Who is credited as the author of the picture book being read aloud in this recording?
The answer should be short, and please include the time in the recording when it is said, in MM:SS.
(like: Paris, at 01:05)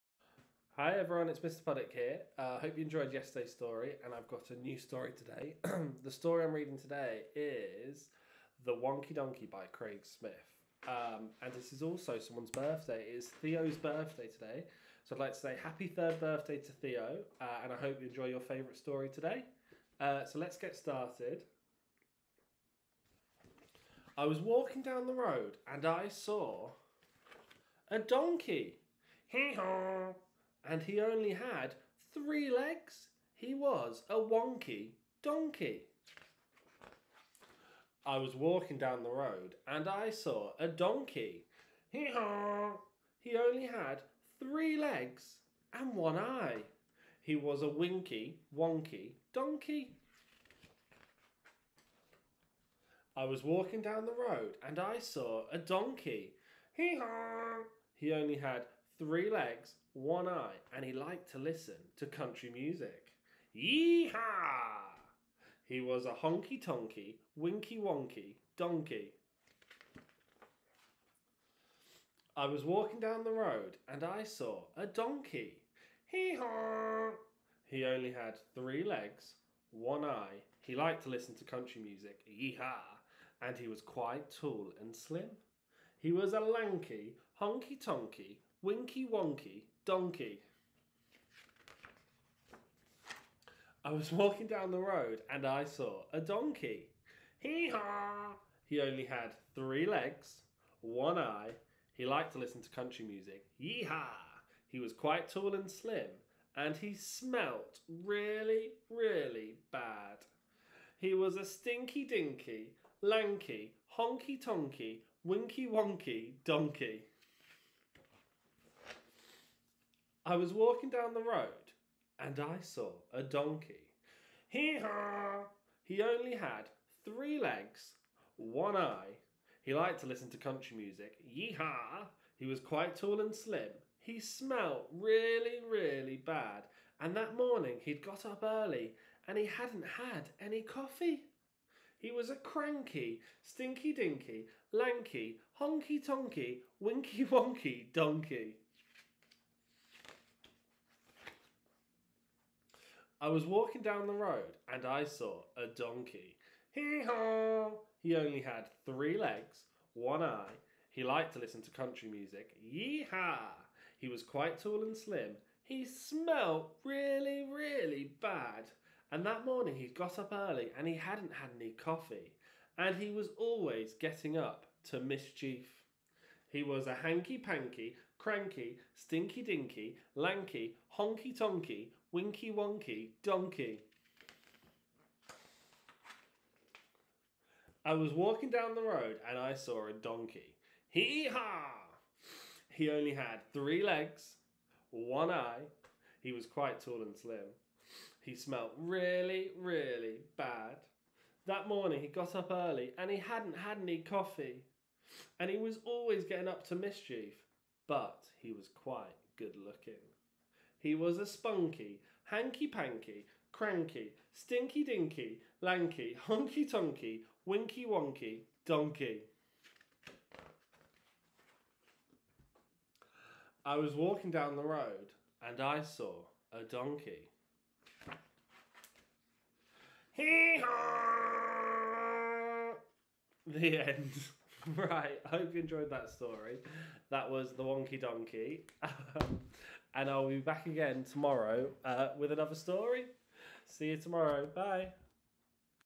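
Craig Smith, at 00:09.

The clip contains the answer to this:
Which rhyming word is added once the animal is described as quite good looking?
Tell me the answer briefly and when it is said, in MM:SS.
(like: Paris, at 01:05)
spunky, at 03:31.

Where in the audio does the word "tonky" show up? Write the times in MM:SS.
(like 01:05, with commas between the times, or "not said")
01:06, 01:27, 01:54, 02:26, 03:01, 03:36.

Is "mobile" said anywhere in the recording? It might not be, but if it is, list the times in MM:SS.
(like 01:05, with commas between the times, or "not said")
not said.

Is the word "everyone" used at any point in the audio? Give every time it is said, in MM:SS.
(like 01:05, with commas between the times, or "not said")
00:00.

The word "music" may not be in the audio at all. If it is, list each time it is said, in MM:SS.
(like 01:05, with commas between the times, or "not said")
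01:02, 01:21, 01:43, 02:10, 02:42.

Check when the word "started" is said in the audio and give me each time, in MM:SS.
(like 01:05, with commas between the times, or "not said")
00:20.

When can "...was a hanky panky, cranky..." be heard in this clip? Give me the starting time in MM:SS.
02:56.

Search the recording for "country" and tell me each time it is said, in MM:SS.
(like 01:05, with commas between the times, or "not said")
01:02, 01:21, 01:42, 02:10, 02:41.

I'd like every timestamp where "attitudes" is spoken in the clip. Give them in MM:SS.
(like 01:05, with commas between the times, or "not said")
not said.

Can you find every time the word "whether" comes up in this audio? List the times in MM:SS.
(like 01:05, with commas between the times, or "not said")
not said.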